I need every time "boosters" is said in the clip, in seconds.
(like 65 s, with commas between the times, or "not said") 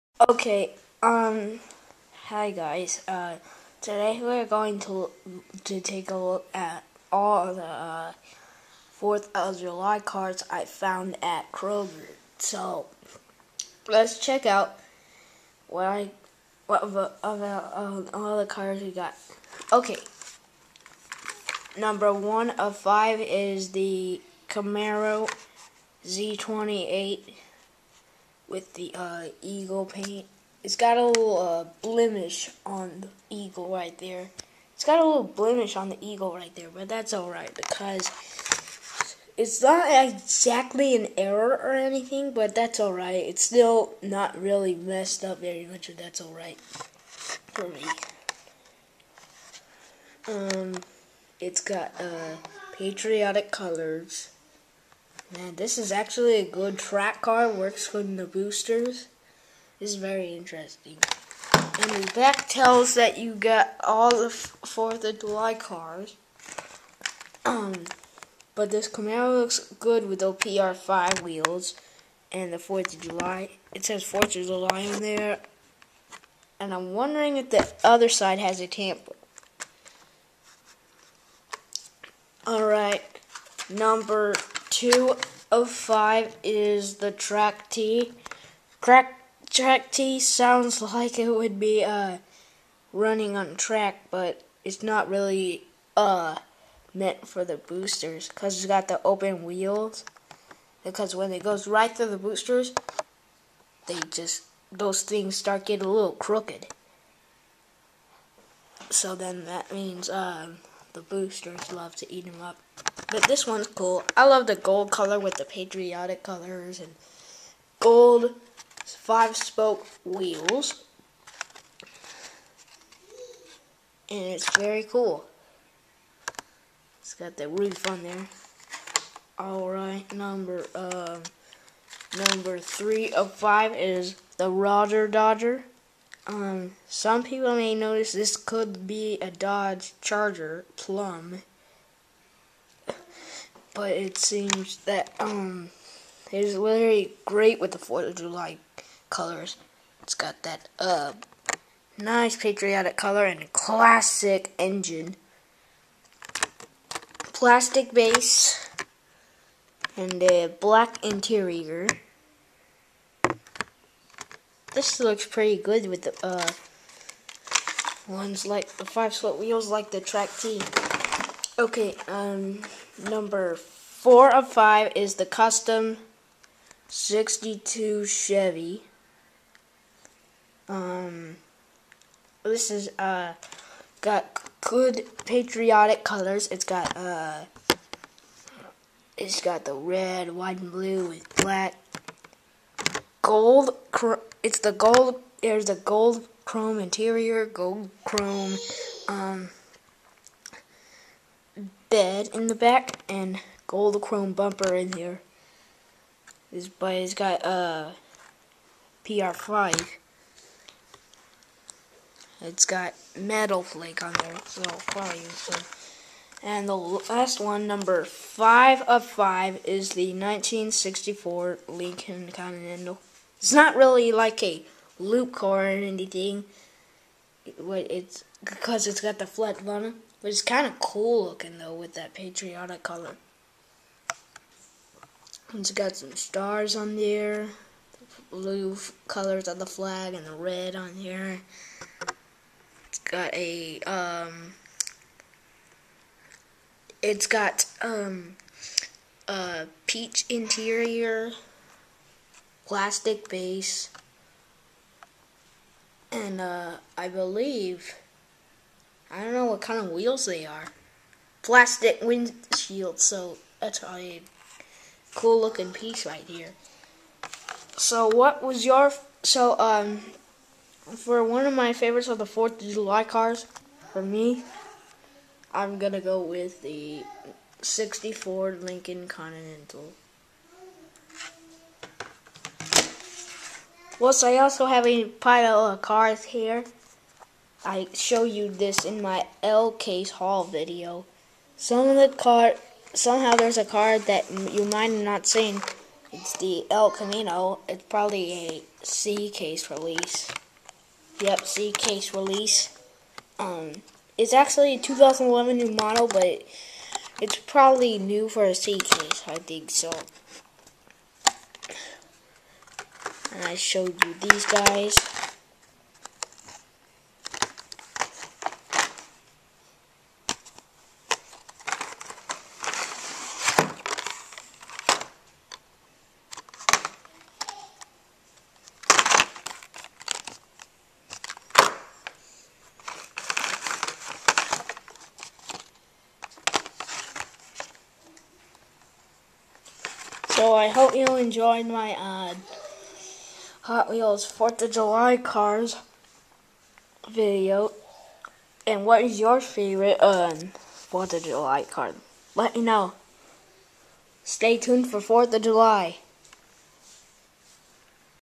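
58 s, 97 s, 102 s, 111 s.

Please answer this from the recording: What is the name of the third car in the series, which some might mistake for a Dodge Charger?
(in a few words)
Rodger Dodger.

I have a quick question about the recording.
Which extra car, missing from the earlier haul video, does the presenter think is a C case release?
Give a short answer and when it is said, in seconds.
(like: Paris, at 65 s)
El Camino, at 296 s.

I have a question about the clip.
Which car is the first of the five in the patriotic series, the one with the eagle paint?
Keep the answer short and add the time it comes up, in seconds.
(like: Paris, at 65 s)
Camaro Z28, at 24 s.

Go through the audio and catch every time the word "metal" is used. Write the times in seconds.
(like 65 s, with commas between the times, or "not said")
213 s.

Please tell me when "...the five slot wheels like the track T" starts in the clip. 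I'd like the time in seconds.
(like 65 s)
168 s.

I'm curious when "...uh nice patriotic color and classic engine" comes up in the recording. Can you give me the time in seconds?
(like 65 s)
150 s.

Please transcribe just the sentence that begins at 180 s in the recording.
Um, this is, uh, got good patriotic colors.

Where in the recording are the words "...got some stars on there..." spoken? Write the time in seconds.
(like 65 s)
235 s.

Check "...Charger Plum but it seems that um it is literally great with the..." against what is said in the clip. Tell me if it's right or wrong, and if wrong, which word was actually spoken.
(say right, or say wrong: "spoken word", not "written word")
right.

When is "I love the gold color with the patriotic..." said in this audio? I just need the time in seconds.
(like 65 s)
114 s.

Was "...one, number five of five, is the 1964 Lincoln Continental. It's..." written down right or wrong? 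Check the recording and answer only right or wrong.
right.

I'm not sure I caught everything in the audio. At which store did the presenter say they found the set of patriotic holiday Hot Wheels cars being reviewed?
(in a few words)
Kroger.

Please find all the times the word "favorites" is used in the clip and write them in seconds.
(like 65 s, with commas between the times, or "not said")
271 s, 349 s.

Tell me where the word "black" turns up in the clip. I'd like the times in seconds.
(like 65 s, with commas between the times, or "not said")
160 s, 191 s.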